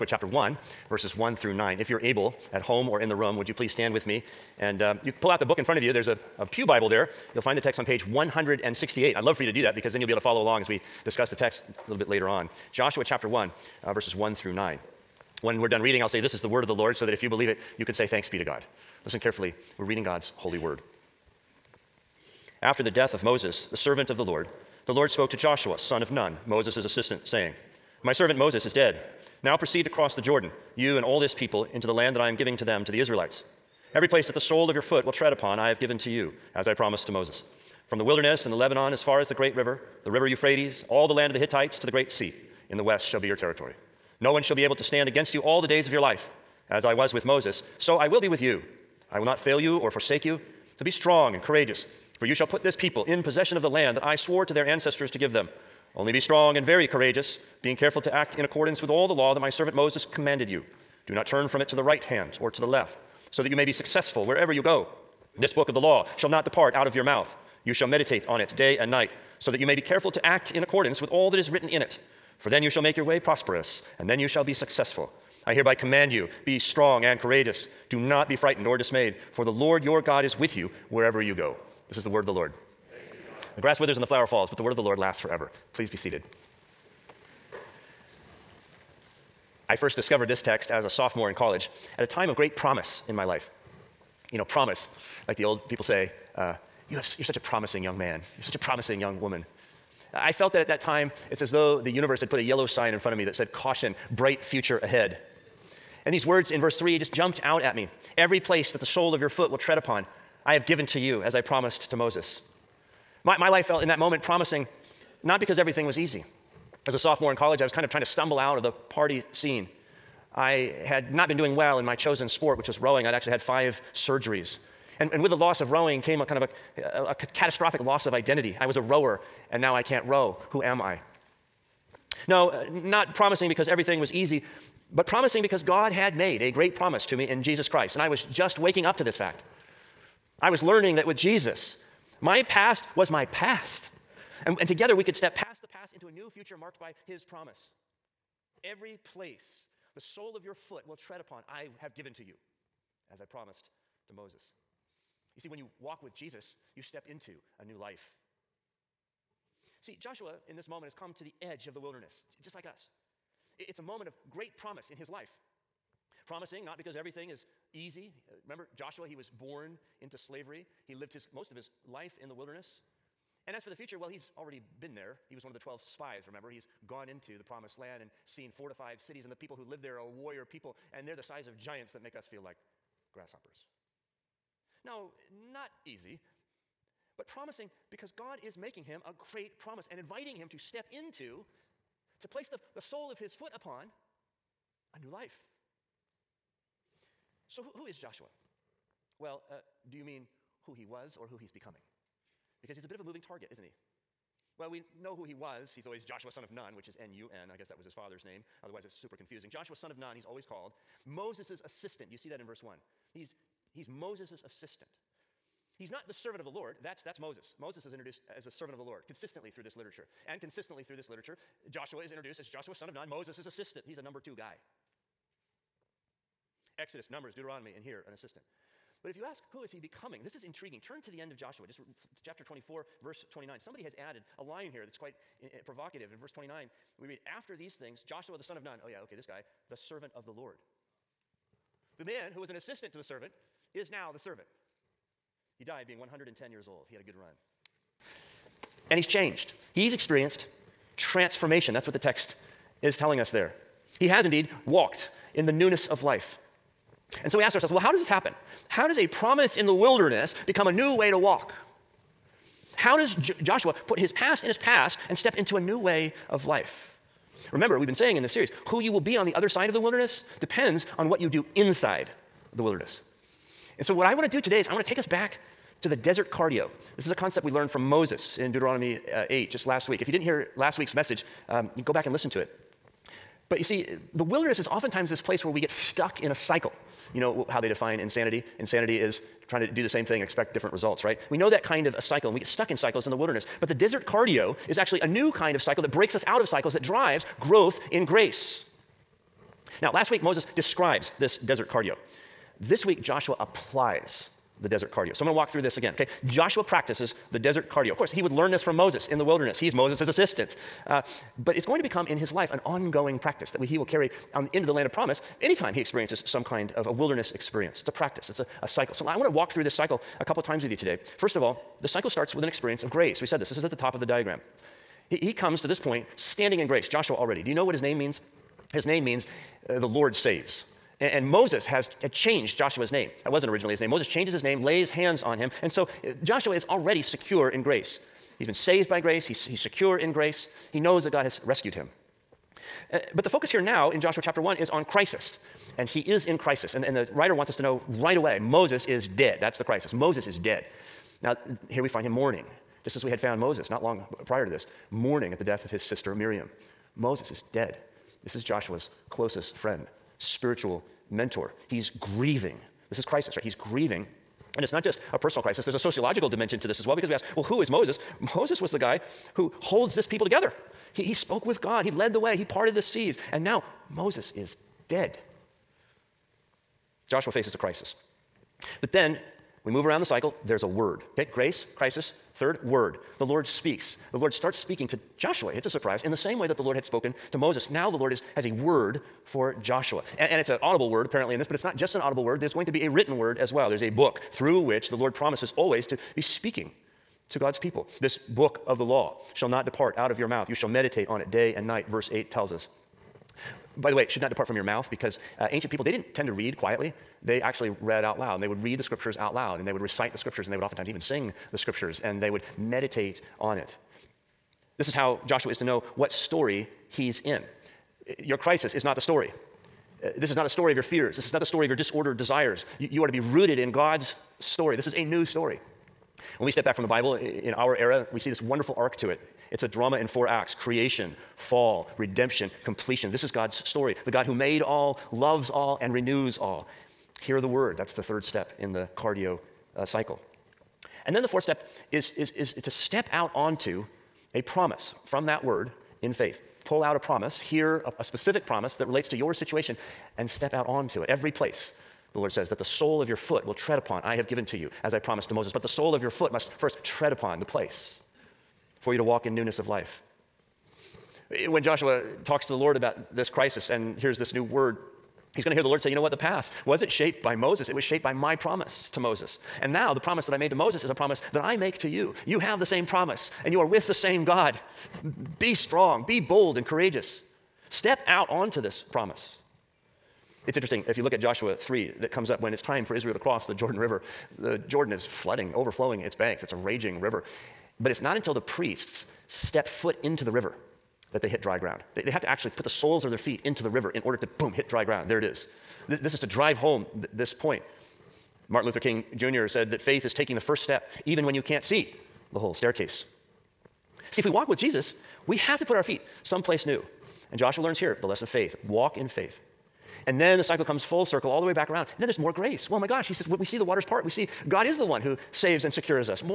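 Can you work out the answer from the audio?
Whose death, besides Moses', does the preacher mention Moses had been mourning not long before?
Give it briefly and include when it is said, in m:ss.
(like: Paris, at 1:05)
Miriam, at 5:56.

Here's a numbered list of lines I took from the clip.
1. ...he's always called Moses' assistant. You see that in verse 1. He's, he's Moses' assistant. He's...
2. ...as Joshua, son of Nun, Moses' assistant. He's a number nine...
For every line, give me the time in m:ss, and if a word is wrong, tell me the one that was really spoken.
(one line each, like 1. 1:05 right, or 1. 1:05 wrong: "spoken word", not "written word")
1. 3:30 right
2. 3:42 wrong: "two", not "nine".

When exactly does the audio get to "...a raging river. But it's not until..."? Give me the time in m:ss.
8:06.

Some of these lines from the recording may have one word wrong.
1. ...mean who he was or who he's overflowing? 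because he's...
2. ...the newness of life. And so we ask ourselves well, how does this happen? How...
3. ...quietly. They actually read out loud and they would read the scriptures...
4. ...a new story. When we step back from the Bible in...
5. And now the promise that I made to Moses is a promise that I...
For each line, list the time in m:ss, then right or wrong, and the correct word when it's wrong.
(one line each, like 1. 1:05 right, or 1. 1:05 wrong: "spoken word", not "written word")
1. 3:20 wrong: "becoming", not "overflowing"
2. 4:15 right
3. 6:46 right
4. 7:04 right
5. 7:49 right.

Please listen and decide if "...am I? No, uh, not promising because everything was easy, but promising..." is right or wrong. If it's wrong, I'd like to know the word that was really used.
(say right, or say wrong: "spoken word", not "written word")
right.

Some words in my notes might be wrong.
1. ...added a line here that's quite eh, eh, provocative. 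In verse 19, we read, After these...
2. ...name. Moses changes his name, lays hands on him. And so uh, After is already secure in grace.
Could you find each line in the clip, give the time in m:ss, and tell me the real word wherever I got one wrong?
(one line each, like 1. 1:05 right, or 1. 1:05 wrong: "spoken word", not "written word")
1. 3:53 wrong: "29", not "19"
2. 5:33 wrong: "Joshua", not "After".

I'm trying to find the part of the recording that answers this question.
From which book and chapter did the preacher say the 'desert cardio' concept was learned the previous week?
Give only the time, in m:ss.
4:38.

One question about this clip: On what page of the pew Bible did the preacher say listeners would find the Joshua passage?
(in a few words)
168.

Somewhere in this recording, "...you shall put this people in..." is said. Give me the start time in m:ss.
0:52.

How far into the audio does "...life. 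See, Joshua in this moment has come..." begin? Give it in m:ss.
2:37.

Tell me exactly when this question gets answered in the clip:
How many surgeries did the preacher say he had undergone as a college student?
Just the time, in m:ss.
2:03.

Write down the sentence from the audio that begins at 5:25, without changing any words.
He, he comes to this point standing in grace, Joshua already.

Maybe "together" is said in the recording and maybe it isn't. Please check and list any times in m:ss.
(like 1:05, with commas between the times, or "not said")
2:24, 6:10.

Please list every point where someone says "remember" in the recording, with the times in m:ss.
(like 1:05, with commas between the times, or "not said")
2:48, 2:56, 4:27.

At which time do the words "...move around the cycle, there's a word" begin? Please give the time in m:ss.
6:19.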